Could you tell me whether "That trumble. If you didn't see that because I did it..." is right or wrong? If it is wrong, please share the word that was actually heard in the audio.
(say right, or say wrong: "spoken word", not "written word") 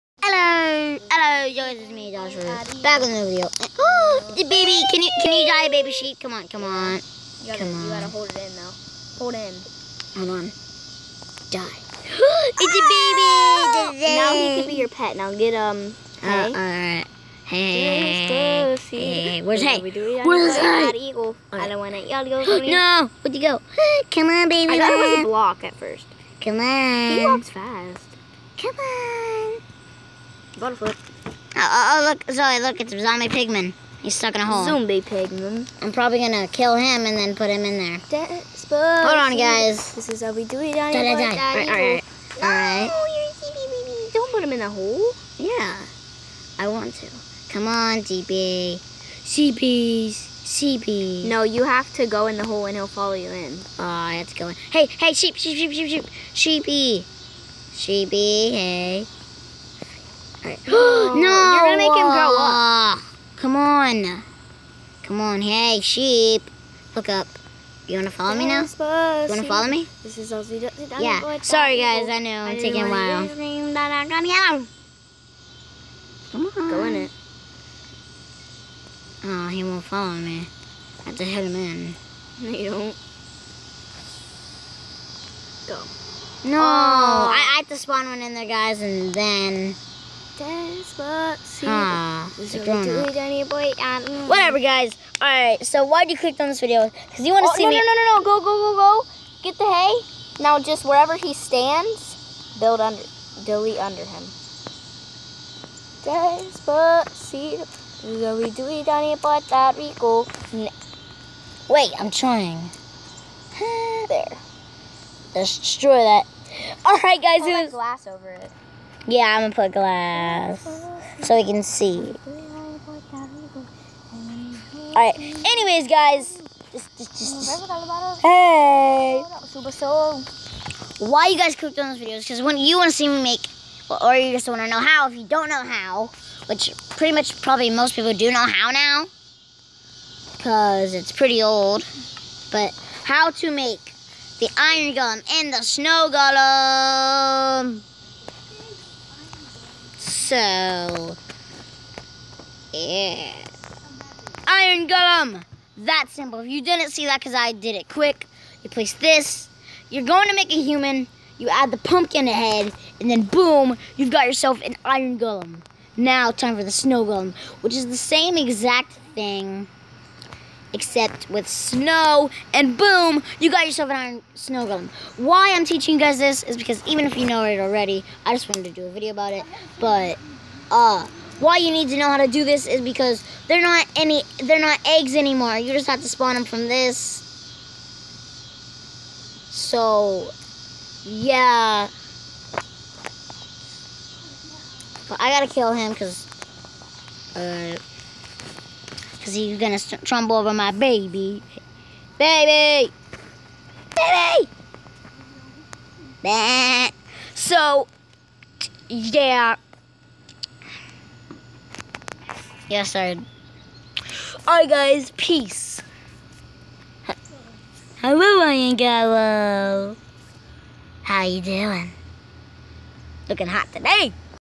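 wrong: "simple", not "trumble".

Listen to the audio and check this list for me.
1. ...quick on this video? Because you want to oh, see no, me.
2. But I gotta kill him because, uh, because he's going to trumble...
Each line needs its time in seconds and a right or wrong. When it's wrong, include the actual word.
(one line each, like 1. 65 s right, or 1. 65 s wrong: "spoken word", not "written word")
1. 96 s wrong: "click", not "quick"
2. 195 s right.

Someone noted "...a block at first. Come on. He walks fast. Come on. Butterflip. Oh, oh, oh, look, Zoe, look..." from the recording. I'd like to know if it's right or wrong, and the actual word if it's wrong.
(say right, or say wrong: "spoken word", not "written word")
right.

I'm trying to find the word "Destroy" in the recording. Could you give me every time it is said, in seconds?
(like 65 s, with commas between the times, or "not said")
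115 s.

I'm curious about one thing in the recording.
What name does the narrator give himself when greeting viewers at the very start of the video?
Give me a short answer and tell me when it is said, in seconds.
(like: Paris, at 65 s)
Joshua, at 2 s.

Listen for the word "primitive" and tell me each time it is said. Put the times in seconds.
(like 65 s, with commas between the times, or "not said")
not said.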